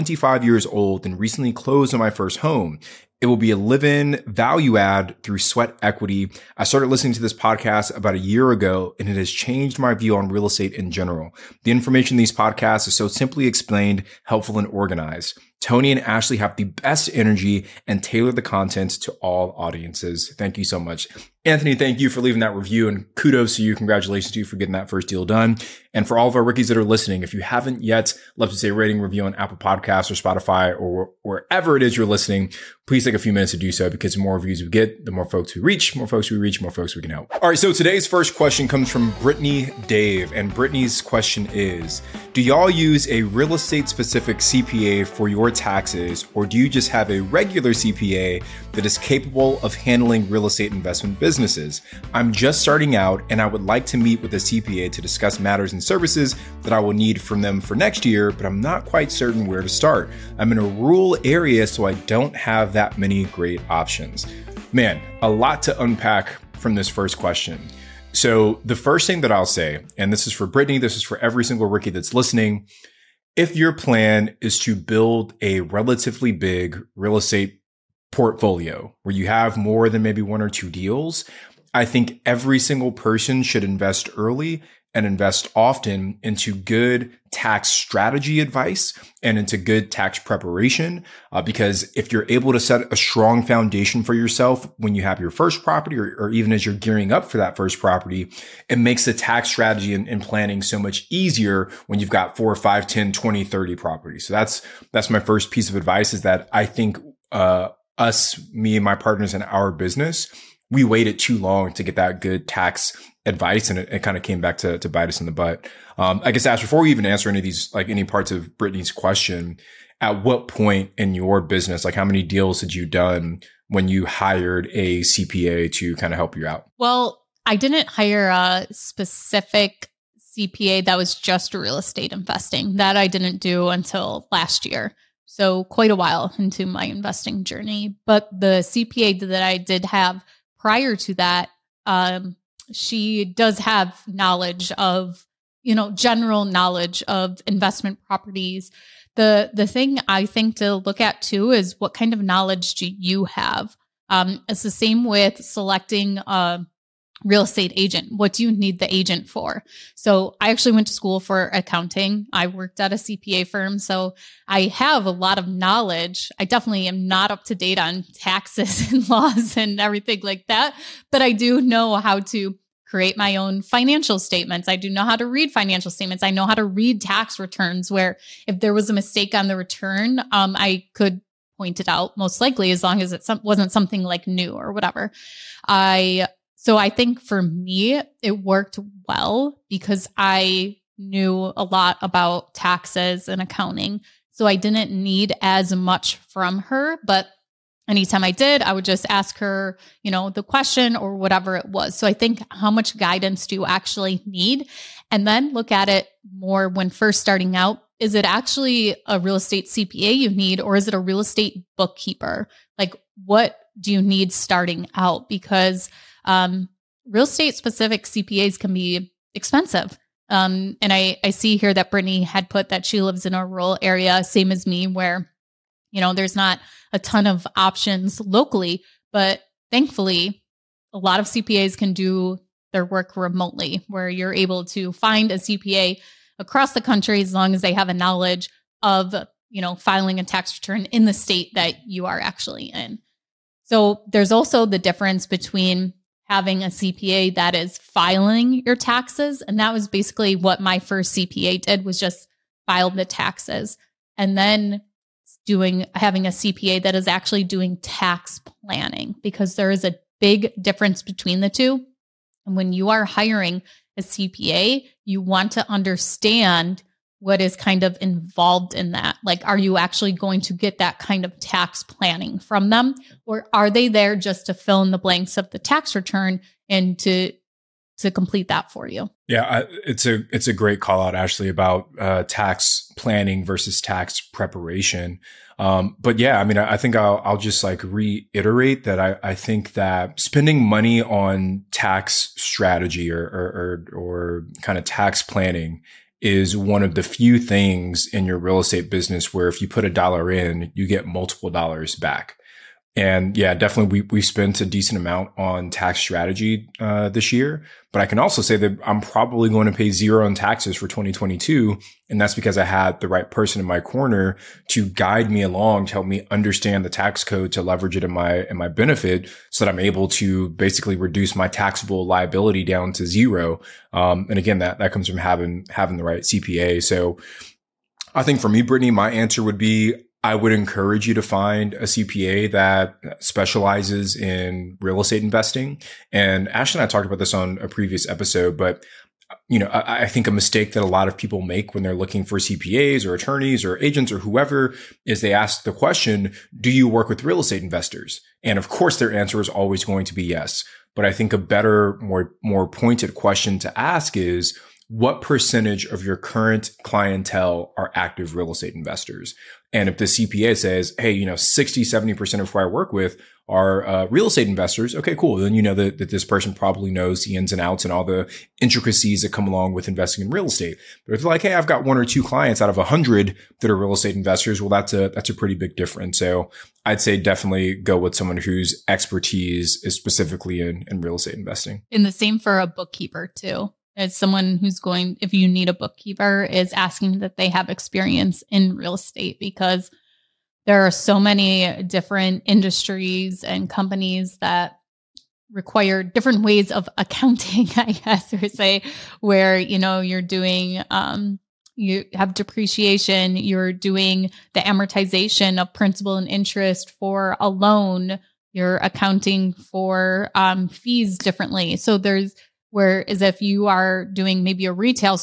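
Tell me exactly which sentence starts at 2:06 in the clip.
Well, I didn't hire a specific CPA that was just real estate investing.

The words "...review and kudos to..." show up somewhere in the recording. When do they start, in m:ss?
0:22.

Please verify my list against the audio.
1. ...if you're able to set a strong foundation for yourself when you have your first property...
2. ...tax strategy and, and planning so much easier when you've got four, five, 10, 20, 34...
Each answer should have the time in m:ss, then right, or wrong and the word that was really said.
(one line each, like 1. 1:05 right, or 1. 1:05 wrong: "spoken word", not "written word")
1. 1:31 right
2. 1:39 wrong: "30", not "34".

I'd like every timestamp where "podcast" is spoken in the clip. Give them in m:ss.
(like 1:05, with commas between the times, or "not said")
0:07, 0:12, 0:29.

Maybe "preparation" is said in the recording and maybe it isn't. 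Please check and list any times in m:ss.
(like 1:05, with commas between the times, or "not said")
1:30, 4:44.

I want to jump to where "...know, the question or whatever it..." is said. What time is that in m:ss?
3:20.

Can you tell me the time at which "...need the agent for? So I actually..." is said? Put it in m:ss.
2:38.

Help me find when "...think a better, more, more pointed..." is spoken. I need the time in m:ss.
5:51.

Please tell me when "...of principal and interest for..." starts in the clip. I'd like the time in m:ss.
6:45.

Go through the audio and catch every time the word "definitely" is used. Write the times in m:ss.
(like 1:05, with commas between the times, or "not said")
2:46, 5:03, 6:17.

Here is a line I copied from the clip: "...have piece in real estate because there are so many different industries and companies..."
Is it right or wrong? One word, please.
wrong.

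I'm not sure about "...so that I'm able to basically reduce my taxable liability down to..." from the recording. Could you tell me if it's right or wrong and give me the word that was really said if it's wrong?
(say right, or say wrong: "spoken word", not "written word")
right.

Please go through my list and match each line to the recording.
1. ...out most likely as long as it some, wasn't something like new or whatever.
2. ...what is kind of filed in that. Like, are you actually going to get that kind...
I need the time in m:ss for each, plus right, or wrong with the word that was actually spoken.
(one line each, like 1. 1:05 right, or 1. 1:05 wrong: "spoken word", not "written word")
1. 3:01 right
2. 4:27 wrong: "involved", not "filed".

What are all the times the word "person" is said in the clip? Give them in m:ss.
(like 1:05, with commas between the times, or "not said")
1:22, 5:13, 6:06.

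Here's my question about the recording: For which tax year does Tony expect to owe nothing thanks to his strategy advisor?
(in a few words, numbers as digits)
2022.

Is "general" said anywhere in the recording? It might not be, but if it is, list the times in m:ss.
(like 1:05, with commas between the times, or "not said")
0:10, 2:25.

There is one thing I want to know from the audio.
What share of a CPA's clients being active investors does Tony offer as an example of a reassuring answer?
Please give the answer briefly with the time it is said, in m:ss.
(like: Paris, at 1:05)
60-70%, at 6:01.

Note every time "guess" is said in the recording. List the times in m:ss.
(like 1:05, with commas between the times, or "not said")
1:56, 6:37.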